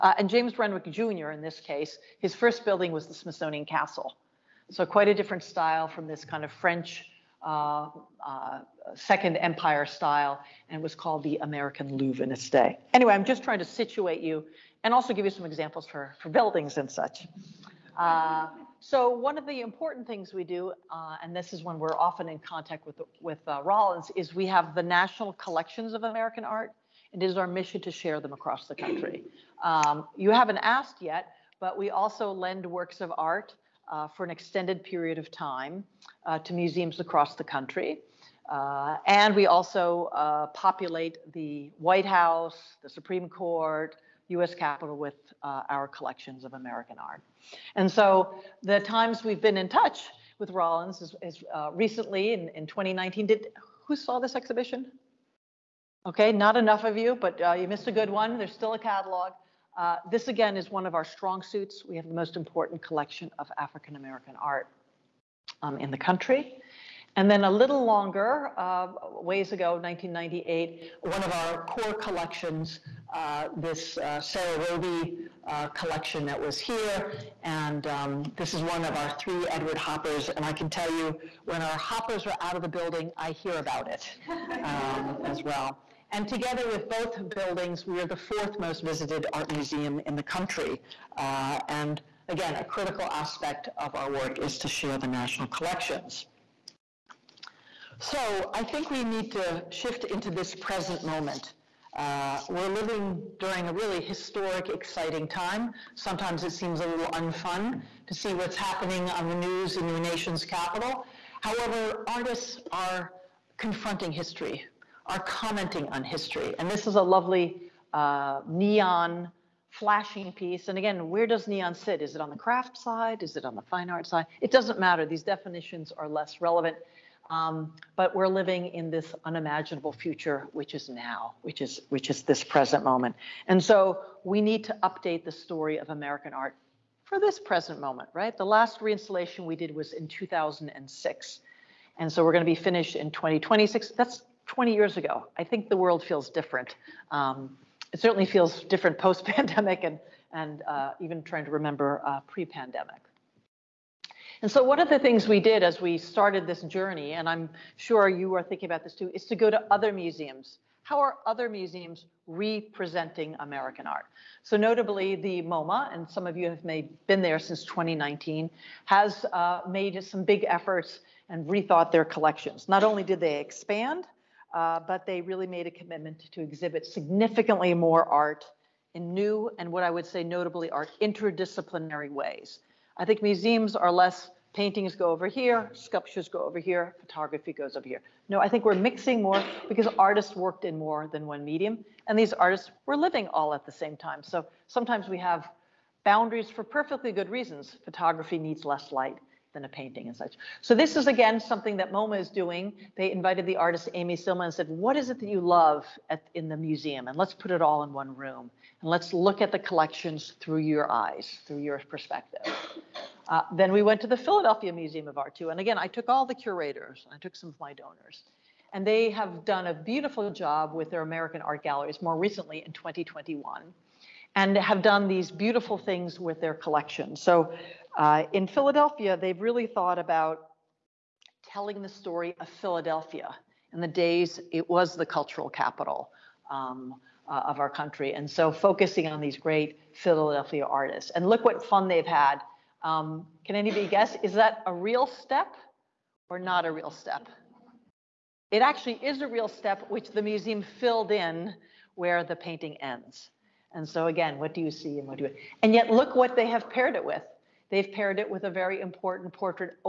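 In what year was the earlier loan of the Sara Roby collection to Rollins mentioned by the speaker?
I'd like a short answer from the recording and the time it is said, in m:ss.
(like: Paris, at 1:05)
1998, at 1:09.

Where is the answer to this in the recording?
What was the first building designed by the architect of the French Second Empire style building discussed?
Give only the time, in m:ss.
0:03.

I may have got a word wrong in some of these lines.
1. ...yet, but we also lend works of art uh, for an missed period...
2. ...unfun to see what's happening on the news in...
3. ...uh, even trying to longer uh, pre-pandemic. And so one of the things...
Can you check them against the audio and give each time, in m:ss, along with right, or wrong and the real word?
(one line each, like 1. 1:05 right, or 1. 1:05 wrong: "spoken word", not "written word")
1. 0:31 wrong: "extended", not "missed"
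2. 1:47 right
3. 2:30 wrong: "remember", not "longer".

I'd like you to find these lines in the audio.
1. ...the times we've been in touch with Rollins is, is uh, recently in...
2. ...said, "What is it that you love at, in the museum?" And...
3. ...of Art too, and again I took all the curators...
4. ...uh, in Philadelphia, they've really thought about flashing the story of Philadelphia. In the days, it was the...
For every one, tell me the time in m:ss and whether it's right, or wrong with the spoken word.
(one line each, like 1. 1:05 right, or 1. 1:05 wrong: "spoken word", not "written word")
1. 0:48 right
2. 3:24 right
3. 3:35 right
4. 3:47 wrong: "telling", not "flashing".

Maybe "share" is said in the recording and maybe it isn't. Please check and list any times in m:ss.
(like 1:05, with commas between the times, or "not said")
0:27, 1:34.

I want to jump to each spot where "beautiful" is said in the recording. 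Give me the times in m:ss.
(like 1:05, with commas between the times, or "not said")
3:39, 3:45.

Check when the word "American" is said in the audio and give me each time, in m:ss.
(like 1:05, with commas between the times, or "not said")
0:11, 0:26, 0:46, 1:03, 2:15, 2:43, 3:41.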